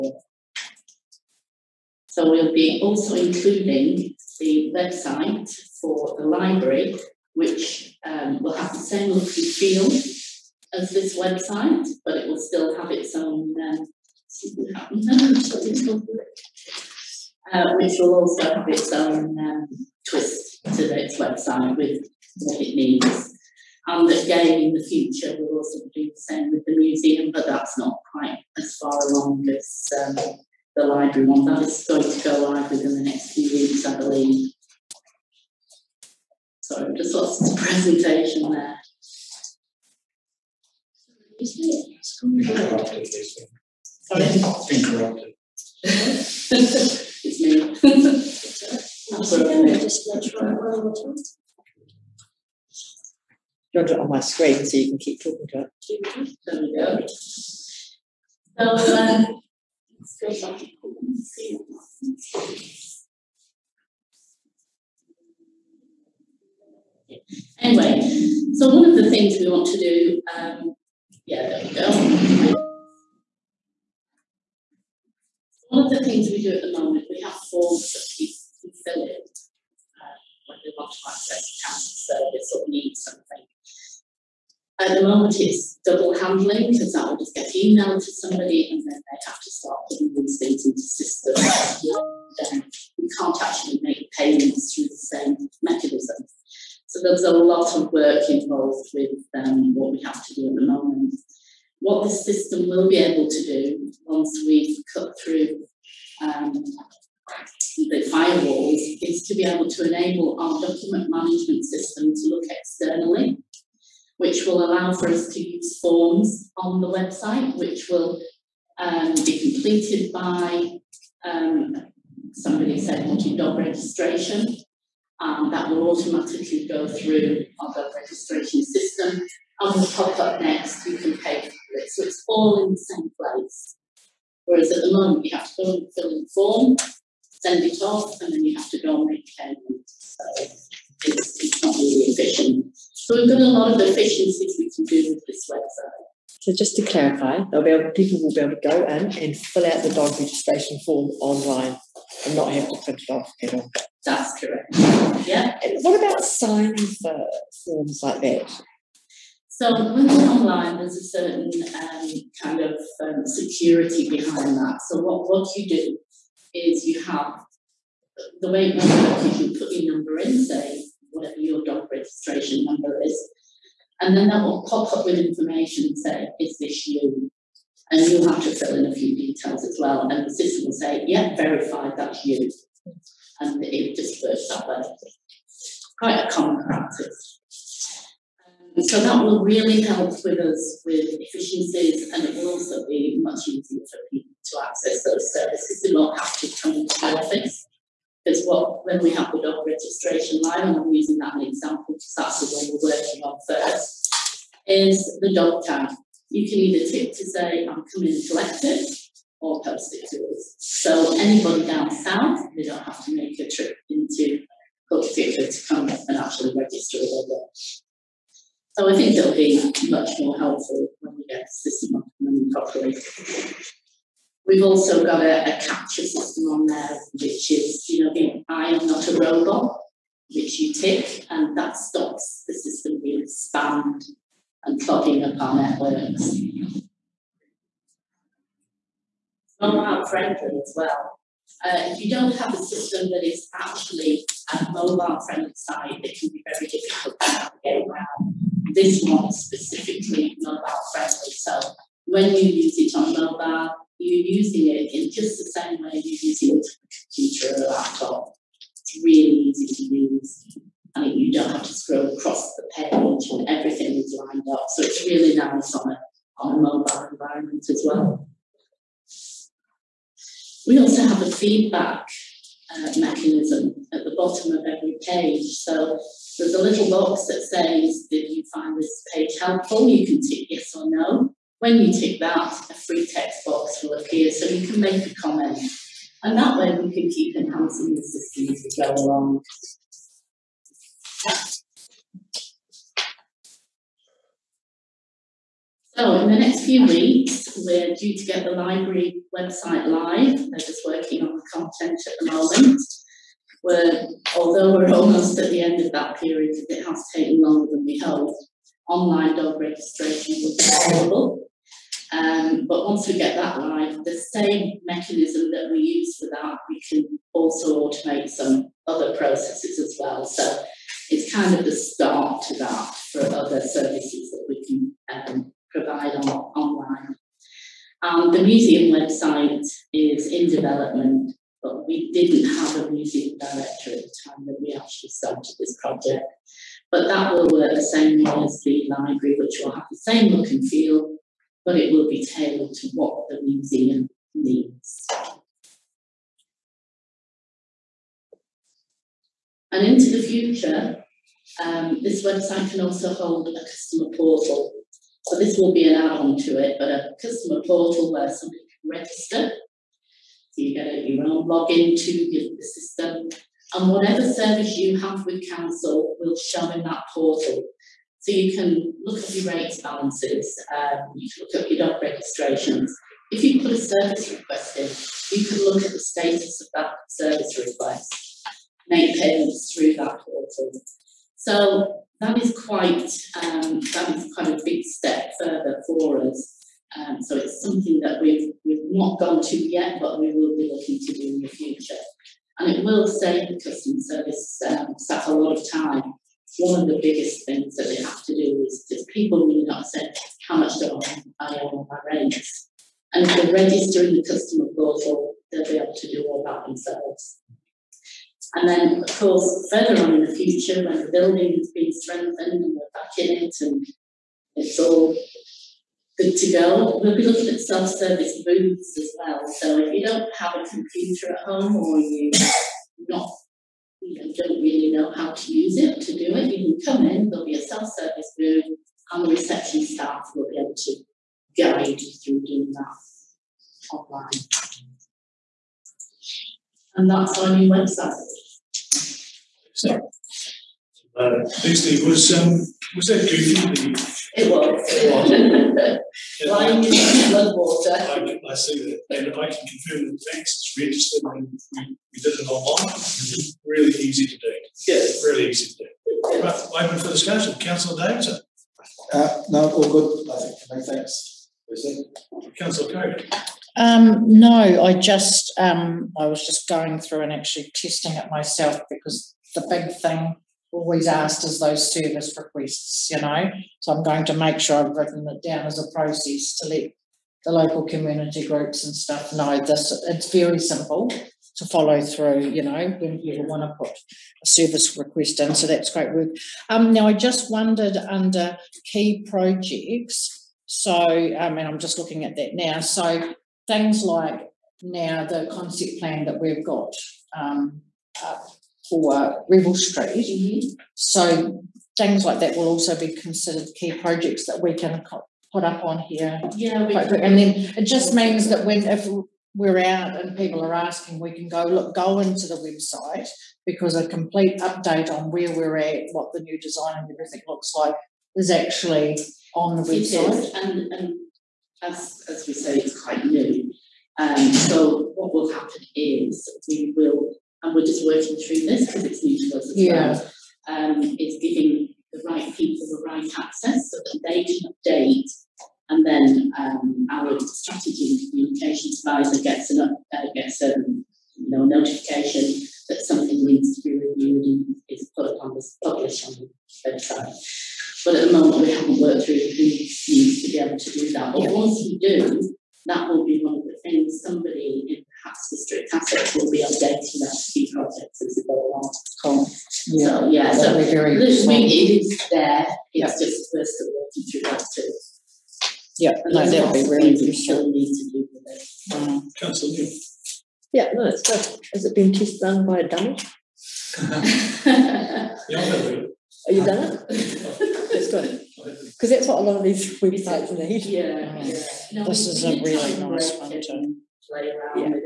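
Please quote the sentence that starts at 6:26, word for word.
Um, so it's something that we've, we've not gone to yet, but we will be looking to do in the future.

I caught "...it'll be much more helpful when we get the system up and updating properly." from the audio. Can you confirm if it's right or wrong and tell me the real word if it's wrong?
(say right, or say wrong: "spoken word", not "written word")
wrong: "running", not "updating".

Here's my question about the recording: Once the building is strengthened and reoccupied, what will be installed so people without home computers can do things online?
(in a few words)
Self-service booths.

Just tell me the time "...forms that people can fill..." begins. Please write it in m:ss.
1:17.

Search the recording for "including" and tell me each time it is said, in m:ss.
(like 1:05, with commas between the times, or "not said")
0:03.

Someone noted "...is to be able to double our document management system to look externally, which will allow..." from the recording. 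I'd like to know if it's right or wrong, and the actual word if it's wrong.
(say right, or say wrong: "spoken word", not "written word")
wrong: "enable", not "double".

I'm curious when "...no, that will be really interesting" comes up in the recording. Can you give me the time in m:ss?
9:26.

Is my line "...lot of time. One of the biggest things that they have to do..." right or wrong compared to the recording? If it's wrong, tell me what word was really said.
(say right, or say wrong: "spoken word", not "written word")
right.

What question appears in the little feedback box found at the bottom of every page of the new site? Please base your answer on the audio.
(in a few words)
Did you find this page helpful?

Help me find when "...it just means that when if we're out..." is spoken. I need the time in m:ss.
8:27.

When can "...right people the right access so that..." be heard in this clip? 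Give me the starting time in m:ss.
8:52.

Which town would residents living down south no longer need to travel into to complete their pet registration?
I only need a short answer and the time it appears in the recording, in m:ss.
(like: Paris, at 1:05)
Cook, at 3:34.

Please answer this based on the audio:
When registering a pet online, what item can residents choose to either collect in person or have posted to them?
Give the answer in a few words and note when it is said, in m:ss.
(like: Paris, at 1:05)
Dog tag, at 3:25.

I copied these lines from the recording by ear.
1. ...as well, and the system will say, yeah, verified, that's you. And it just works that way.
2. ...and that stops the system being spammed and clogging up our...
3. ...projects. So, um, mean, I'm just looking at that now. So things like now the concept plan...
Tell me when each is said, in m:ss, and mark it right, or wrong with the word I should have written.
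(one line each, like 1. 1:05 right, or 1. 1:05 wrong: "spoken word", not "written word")
1. 2:59 right
2. 3:51 right
3. 8:09 right.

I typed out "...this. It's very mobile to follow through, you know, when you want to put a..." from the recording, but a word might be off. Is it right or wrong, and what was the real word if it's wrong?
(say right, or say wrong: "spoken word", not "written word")
wrong: "simple", not "mobile".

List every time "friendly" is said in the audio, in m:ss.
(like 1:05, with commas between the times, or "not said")
4:00, 4:05, 4:10.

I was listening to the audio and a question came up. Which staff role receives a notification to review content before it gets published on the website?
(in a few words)
Strategy and communications advisor.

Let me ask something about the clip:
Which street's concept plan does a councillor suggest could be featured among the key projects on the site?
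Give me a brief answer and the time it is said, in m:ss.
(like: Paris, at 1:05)
Revell Street, at 8:19.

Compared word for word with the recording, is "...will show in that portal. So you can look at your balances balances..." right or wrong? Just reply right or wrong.
wrong.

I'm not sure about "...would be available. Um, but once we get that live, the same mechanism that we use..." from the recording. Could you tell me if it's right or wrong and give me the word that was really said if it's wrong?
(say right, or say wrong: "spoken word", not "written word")
right.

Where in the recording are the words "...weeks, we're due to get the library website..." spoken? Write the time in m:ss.
4:56.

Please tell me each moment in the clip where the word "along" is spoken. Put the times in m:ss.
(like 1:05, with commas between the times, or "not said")
0:29, 4:48, 9:18.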